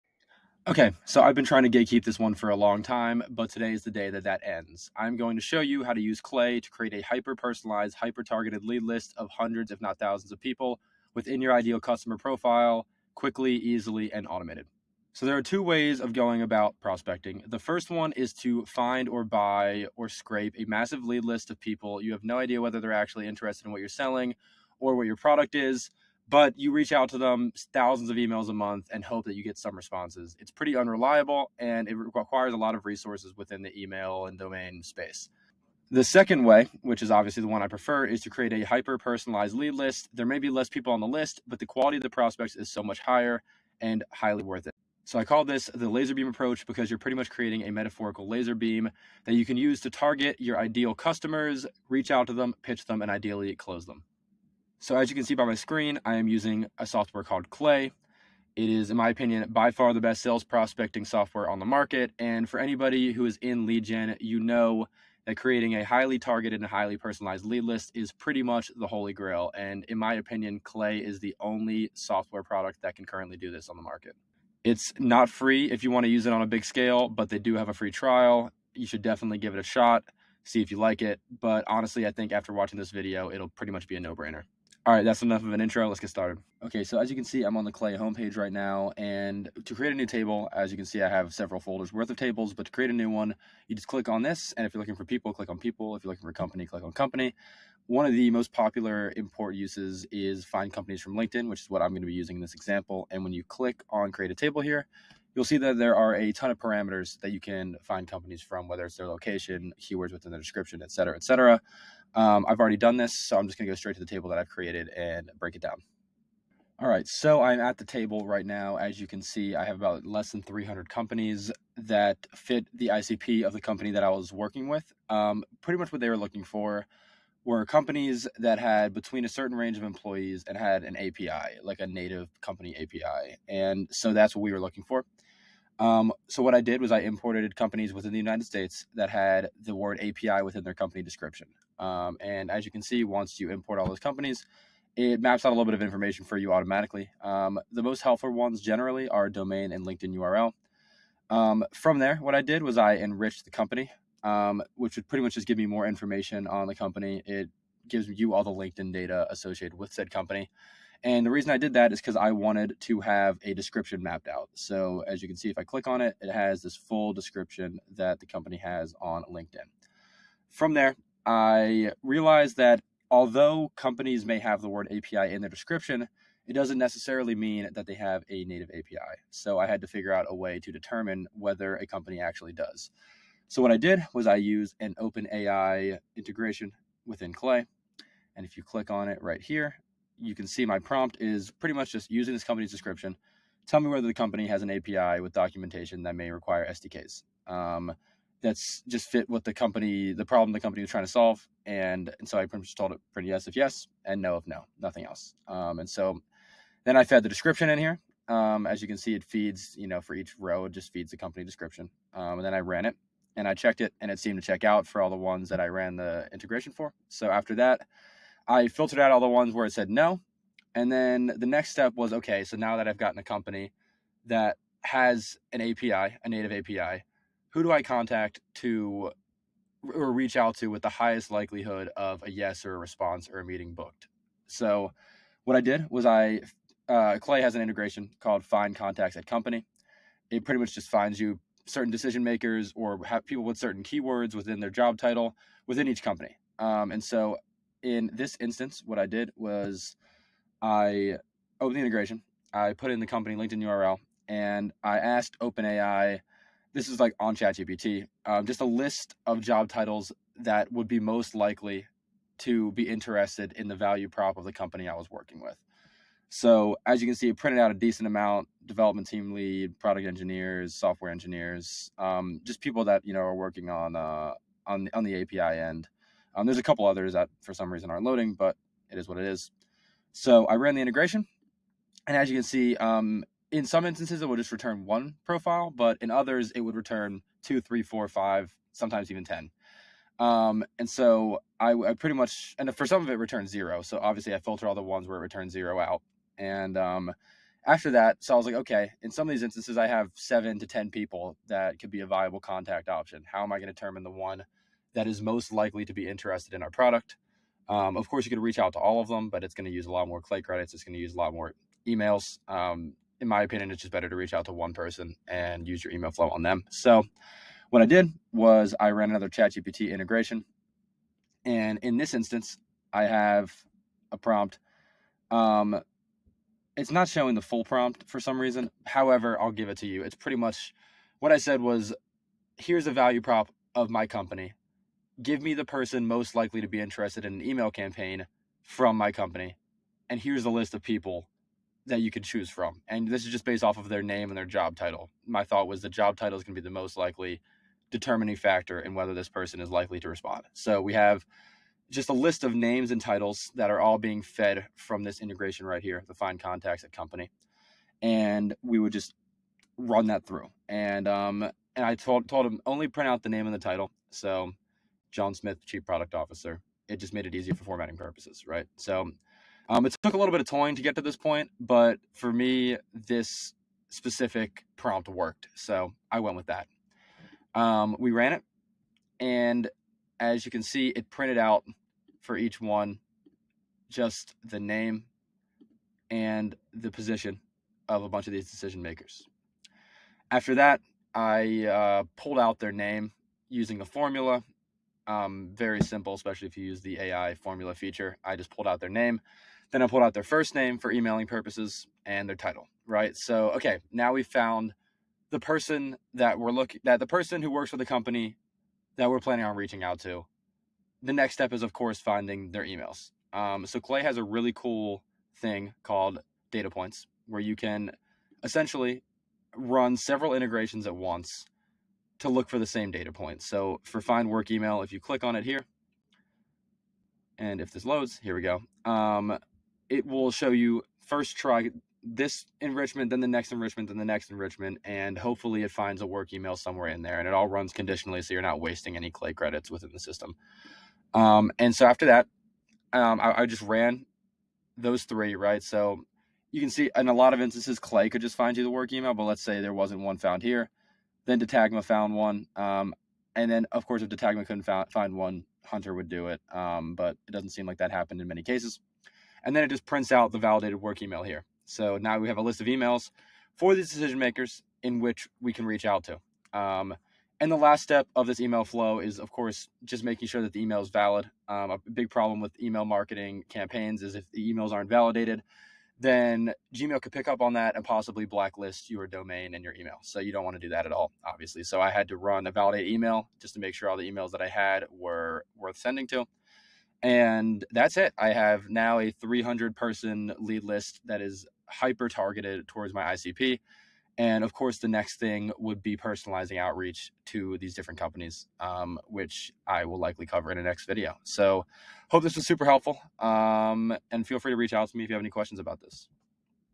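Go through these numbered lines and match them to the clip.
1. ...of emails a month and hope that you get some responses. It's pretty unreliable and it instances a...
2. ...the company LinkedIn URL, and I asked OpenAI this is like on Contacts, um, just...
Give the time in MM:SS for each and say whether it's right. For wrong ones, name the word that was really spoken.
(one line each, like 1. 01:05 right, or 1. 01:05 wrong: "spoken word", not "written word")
1. 00:28 wrong: "requires", not "instances"
2. 04:12 wrong: "ChatGPT", not "Contacts".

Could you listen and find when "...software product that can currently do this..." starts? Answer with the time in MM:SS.
01:11.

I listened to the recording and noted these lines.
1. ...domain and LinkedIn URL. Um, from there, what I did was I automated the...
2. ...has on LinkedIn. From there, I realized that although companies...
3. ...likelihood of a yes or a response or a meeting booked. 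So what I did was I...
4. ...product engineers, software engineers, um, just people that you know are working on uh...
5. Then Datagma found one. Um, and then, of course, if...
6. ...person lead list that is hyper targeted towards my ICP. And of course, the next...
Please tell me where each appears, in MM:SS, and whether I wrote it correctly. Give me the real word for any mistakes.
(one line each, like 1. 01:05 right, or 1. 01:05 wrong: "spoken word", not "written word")
1. 02:29 wrong: "enriched", not "automated"
2. 02:48 right
3. 03:51 right
4. 04:29 right
5. 07:31 right
6. 08:09 right.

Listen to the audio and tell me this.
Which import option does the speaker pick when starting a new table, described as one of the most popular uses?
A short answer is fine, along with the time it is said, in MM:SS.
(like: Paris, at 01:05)
Find companies from LinkedIn, at 01:40.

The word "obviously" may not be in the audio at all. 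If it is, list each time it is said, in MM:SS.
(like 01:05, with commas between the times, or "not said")
00:37, 04:54, 08:01.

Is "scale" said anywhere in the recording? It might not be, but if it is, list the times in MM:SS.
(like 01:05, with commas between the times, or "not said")
01:16.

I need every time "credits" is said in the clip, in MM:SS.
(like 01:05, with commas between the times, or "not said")
05:10, 07:19.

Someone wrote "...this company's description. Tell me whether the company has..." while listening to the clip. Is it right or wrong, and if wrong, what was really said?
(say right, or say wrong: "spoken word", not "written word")
right.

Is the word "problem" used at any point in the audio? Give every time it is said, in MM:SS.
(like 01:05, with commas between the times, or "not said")
03:20, 07:52.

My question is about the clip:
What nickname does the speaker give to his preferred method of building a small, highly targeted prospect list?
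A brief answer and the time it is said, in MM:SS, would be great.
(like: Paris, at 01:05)
laser beam approach, at 00:45.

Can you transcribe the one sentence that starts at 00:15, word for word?
So there are two ways of going about prospecting.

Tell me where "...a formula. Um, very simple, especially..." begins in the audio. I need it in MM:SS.
06:33.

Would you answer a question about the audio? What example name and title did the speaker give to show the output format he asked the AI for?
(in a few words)
John Smith, Chief Product Officer.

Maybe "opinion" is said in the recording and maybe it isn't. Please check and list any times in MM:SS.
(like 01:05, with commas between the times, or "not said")
00:59, 01:10, 05:13.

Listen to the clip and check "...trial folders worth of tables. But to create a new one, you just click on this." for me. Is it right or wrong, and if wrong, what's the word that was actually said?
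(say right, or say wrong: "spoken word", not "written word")
wrong: "several", not "trial".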